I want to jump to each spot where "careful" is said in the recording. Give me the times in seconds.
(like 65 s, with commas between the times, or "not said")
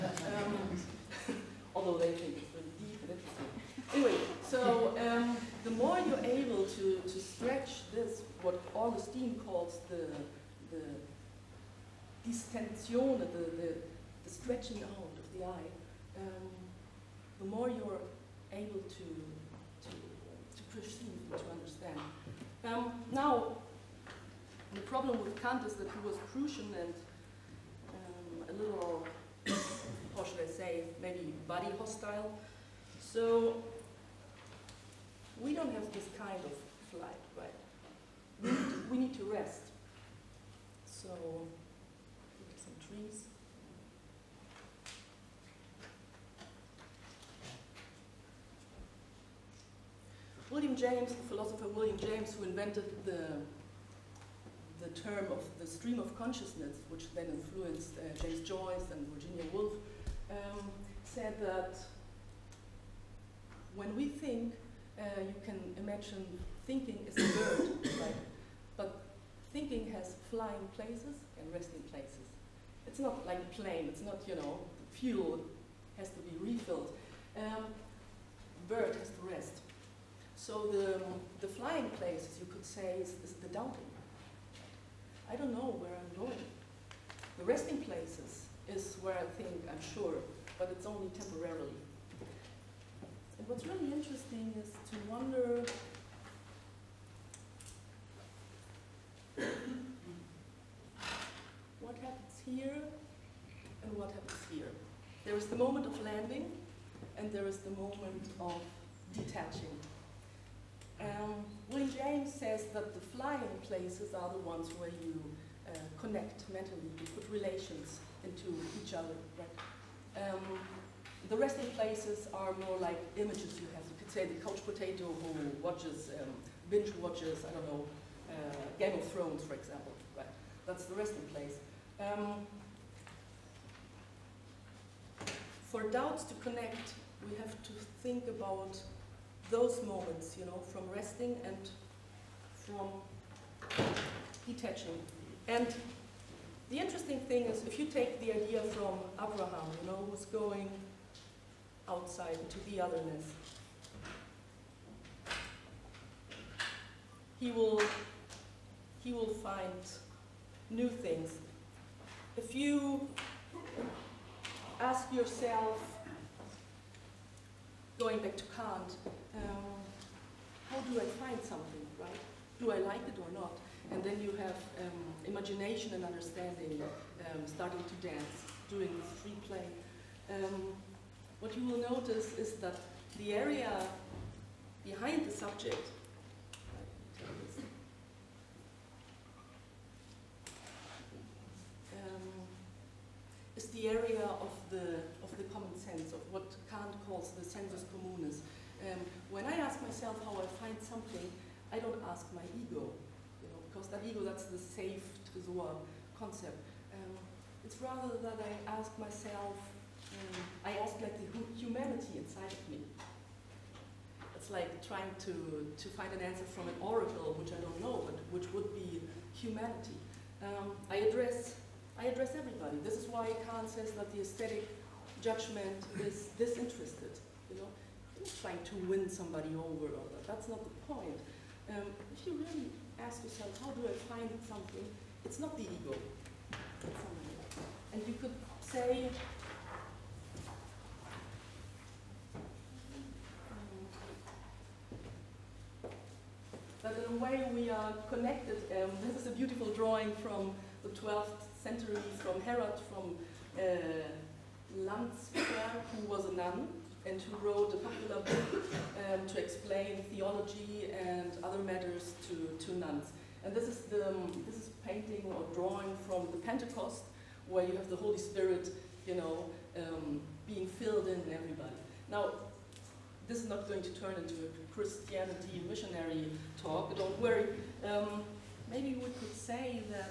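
not said.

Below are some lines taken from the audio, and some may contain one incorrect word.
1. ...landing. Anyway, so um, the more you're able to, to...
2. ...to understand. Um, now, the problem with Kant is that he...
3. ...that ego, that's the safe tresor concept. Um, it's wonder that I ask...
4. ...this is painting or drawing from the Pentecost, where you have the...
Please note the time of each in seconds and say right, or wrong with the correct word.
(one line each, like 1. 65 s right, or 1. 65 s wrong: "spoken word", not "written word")
1. 3 s wrong: "interesting", not "landing"
2. 21 s right
3. 203 s wrong: "rather", not "wonder"
4. 264 s right.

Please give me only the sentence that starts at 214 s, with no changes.
It's like trying to, to find an answer from an oracle, which I don't know, but which would be humanity.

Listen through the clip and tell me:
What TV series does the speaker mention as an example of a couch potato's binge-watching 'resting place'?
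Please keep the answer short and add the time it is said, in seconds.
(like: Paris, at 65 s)
Game of Thrones, at 128 s.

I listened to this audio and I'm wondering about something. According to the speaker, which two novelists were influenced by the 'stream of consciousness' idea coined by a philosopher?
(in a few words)
James Joyce and Virginia Woolf.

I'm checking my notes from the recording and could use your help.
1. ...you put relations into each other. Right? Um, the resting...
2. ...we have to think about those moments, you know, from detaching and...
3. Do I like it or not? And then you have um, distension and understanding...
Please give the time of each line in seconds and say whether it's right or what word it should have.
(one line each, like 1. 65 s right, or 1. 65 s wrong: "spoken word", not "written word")
1. 116 s right
2. 137 s wrong: "resting", not "detaching"
3. 172 s wrong: "imagination", not "distension".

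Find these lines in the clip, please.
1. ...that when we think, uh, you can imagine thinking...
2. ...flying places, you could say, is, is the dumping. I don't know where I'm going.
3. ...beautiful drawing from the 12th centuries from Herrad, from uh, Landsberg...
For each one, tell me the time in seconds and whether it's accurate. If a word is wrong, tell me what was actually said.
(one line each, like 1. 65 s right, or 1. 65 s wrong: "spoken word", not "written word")
1. 61 s right
2. 81 s right
3. 249 s right.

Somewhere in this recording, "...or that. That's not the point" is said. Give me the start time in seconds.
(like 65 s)
229 s.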